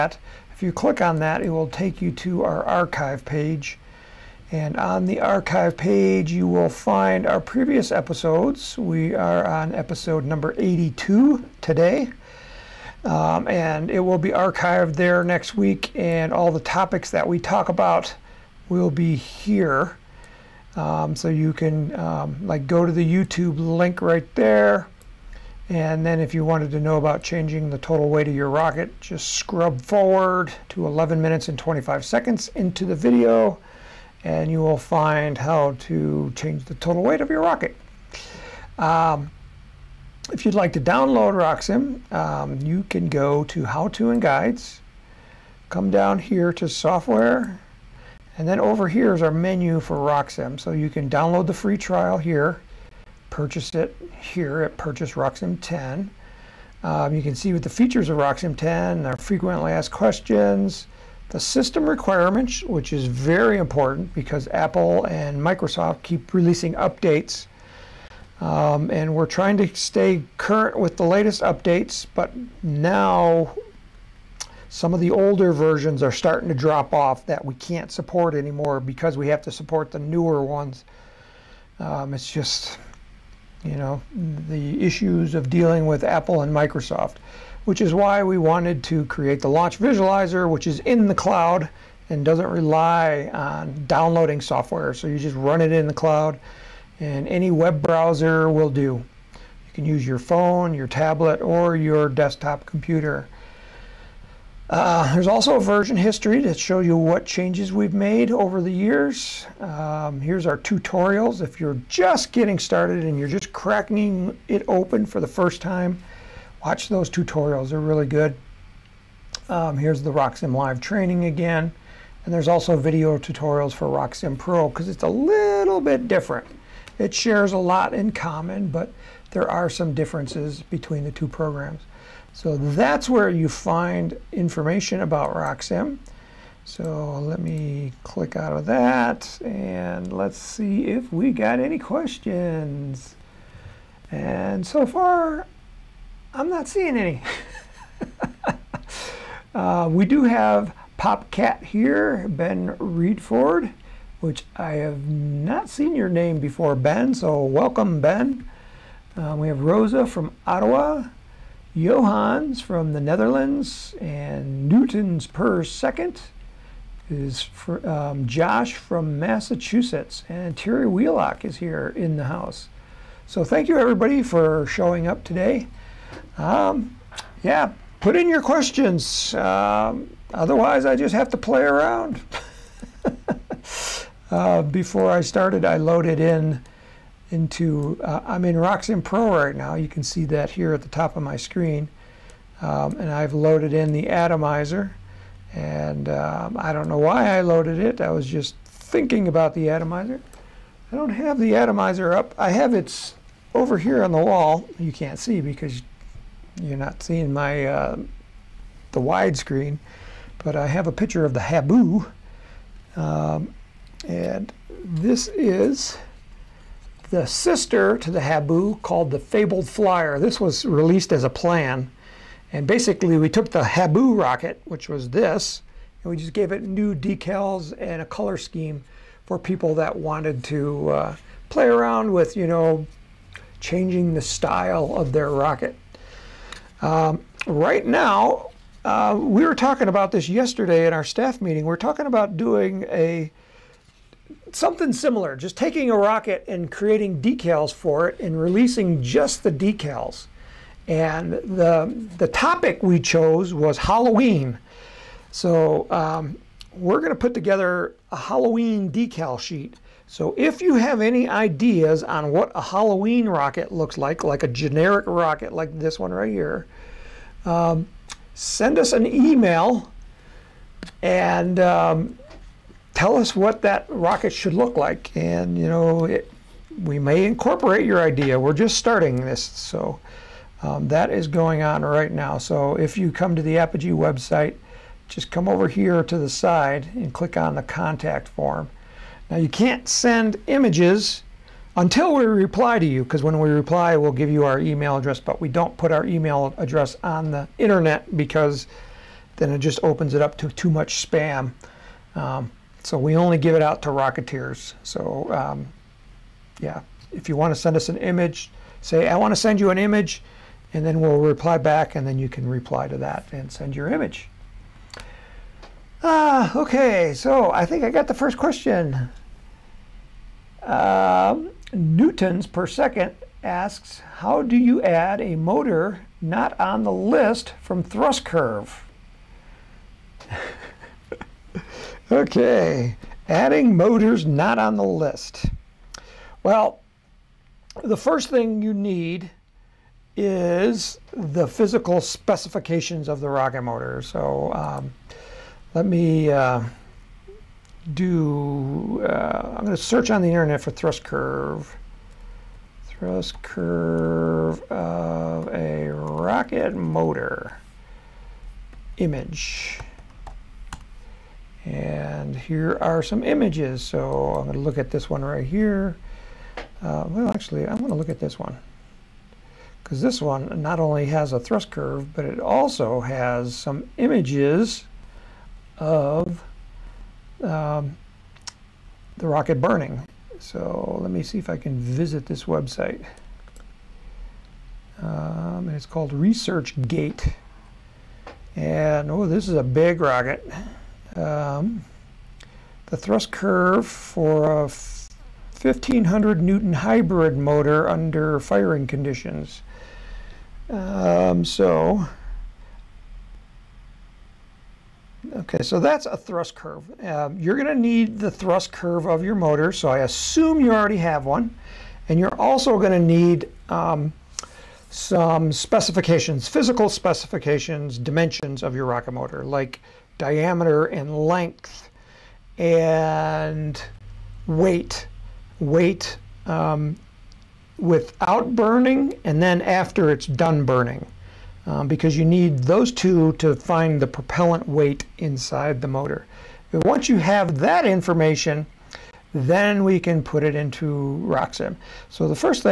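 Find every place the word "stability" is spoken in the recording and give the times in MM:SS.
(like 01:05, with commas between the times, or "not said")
not said.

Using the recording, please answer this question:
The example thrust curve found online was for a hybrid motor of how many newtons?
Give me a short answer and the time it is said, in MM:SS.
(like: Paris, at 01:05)
1500, at 06:34.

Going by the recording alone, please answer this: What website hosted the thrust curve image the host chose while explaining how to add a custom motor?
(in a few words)
ResearchGate.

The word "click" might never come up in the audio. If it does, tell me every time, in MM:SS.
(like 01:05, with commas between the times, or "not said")
00:00, 02:18, 04:47.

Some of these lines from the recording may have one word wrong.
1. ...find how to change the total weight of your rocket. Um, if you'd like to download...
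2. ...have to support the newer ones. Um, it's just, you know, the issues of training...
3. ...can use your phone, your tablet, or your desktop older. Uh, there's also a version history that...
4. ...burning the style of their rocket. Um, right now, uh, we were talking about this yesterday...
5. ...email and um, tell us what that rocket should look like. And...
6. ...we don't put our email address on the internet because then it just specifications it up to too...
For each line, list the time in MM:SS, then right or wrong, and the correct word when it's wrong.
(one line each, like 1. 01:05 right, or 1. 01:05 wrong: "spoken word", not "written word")
1. 00:34 right
2. 01:19 wrong: "dealing", not "training"
3. 01:39 wrong: "computer", not "older"
4. 03:53 wrong: "changing", not "burning"
5. 04:29 right
6. 04:55 wrong: "opens", not "specifications".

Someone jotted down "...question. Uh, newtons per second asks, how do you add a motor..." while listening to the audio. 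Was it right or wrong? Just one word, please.
right.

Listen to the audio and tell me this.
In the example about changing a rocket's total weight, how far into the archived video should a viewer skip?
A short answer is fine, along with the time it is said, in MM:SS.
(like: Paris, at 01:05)
11 minutes 25 seconds, at 00:30.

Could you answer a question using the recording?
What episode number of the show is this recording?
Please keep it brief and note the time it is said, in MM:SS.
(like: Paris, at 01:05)
82, at 00:09.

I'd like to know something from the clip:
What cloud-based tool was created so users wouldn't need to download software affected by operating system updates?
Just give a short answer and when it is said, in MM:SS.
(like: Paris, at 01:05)
Launch visualizer, at 01:29.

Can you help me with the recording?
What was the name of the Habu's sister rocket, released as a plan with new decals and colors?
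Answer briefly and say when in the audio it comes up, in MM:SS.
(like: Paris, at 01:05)
Fabled Flyer, at 03:39.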